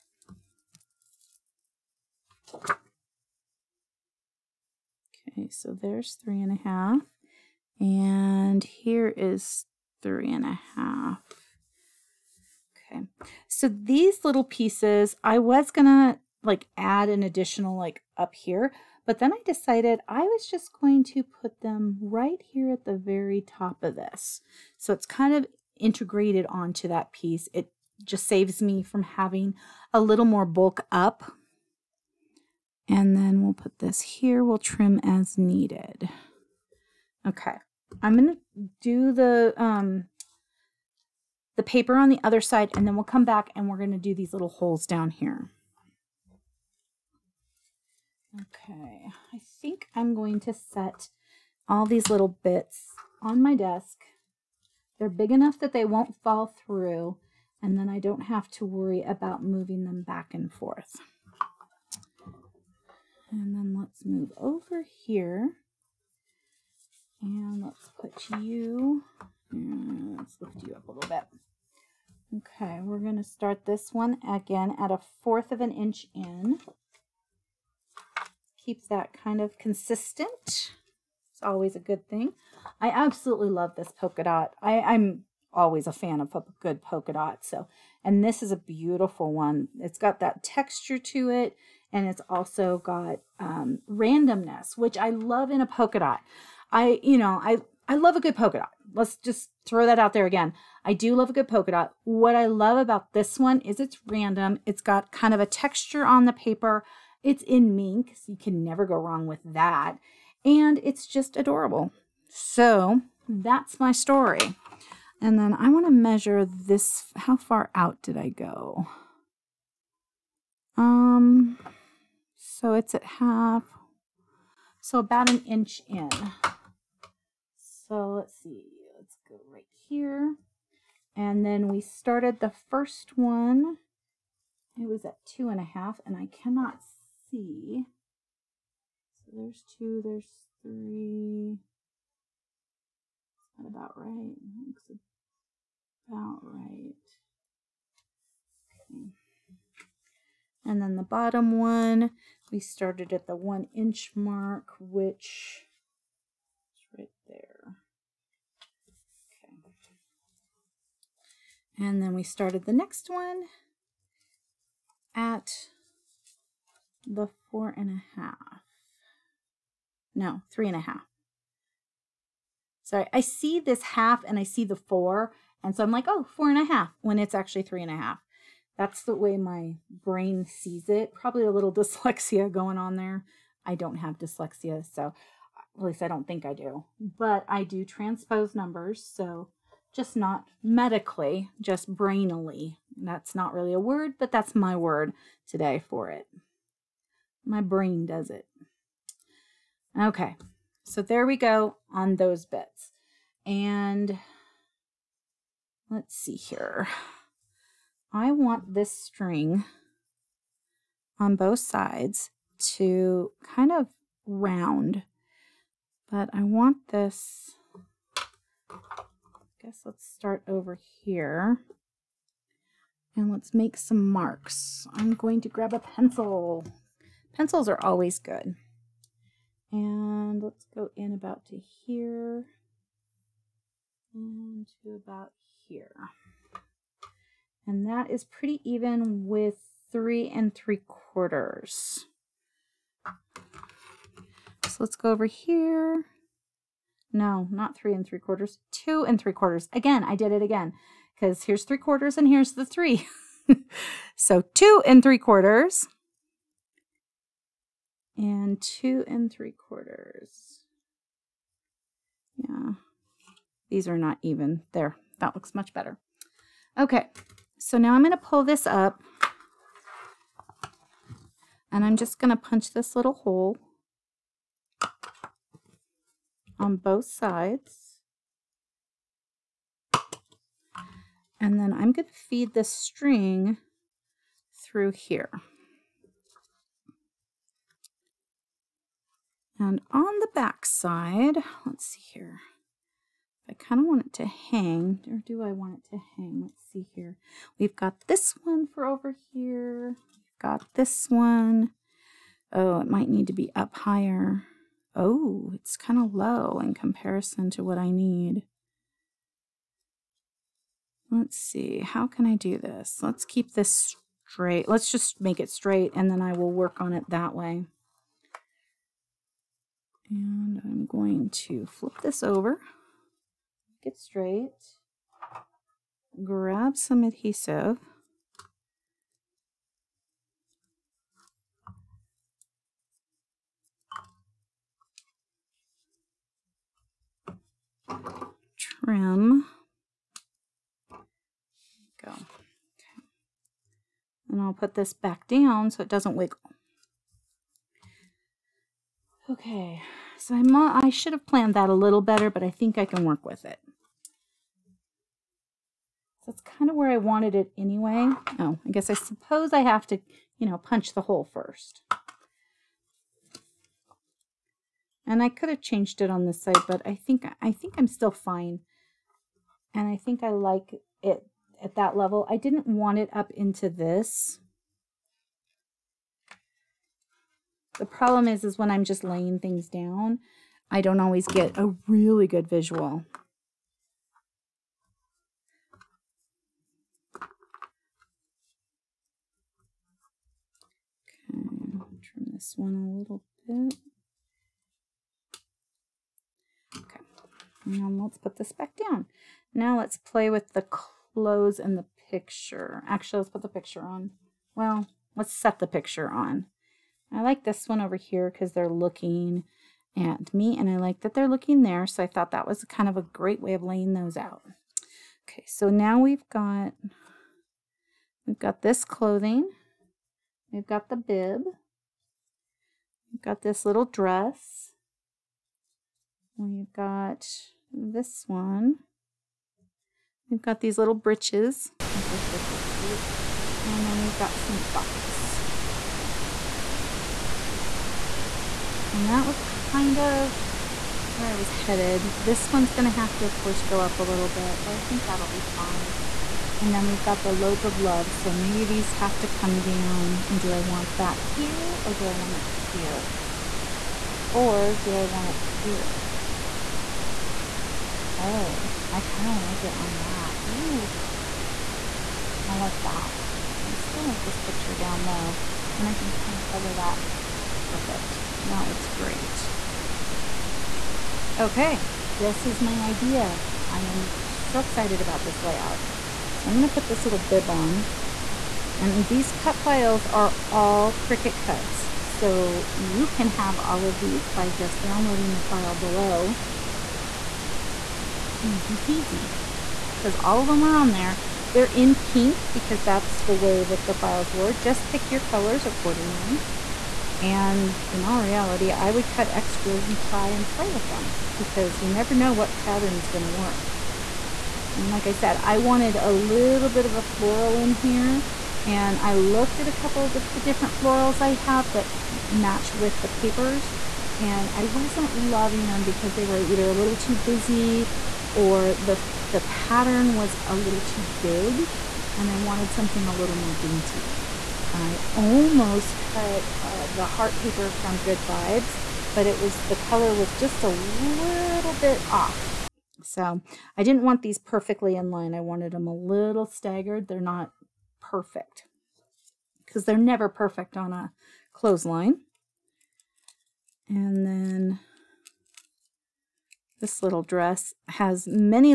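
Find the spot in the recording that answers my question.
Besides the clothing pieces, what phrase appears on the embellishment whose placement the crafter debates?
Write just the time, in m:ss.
7:27.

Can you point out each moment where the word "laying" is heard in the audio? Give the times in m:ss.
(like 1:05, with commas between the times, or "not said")
6:19, 6:53.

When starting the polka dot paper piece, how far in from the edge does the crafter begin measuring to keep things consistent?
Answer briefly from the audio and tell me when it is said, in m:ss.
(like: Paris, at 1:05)
1/4 inch, at 1:14.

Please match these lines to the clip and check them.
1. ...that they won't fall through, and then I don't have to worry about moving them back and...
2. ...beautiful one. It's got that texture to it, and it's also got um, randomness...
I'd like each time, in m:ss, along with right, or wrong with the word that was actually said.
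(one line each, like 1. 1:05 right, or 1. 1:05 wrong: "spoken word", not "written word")
1. 0:55 right
2. 1:28 right.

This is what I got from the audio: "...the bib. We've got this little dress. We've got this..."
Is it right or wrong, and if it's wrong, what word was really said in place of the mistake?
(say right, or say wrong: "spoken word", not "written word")
right.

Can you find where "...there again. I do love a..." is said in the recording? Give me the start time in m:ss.
1:40.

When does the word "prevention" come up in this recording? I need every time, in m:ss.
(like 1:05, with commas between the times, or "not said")
not said.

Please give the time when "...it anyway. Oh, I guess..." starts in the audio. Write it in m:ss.
5:57.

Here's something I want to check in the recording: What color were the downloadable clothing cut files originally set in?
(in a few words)
pink.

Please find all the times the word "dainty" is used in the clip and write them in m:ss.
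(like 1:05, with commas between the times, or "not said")
8:43.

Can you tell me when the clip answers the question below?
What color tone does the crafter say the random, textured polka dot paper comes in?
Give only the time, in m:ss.
1:47.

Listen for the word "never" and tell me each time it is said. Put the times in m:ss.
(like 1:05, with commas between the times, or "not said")
1:48, 8:21, 8:59.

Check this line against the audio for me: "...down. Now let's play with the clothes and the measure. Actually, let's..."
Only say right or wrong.
wrong.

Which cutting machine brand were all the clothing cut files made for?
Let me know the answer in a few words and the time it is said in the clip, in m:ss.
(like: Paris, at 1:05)
Cricut, at 8:00.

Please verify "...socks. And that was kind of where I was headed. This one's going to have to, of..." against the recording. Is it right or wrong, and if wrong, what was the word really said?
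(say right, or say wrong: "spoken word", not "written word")
right.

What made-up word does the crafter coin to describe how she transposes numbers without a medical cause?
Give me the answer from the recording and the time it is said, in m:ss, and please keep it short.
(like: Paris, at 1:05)
brainily, at 3:11.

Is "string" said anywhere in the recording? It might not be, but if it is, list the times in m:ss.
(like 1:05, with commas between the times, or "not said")
3:28, 4:42.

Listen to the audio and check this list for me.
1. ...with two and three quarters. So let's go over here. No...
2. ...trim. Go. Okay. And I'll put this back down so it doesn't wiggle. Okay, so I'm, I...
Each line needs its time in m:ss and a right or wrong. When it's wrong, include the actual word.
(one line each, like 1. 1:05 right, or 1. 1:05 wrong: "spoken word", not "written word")
1. 3:59 wrong: "three", not "two"
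2. 5:38 right.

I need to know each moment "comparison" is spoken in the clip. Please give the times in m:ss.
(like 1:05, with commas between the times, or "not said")
5:06.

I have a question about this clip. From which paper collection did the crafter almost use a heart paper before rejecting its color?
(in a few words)
Good Vibes.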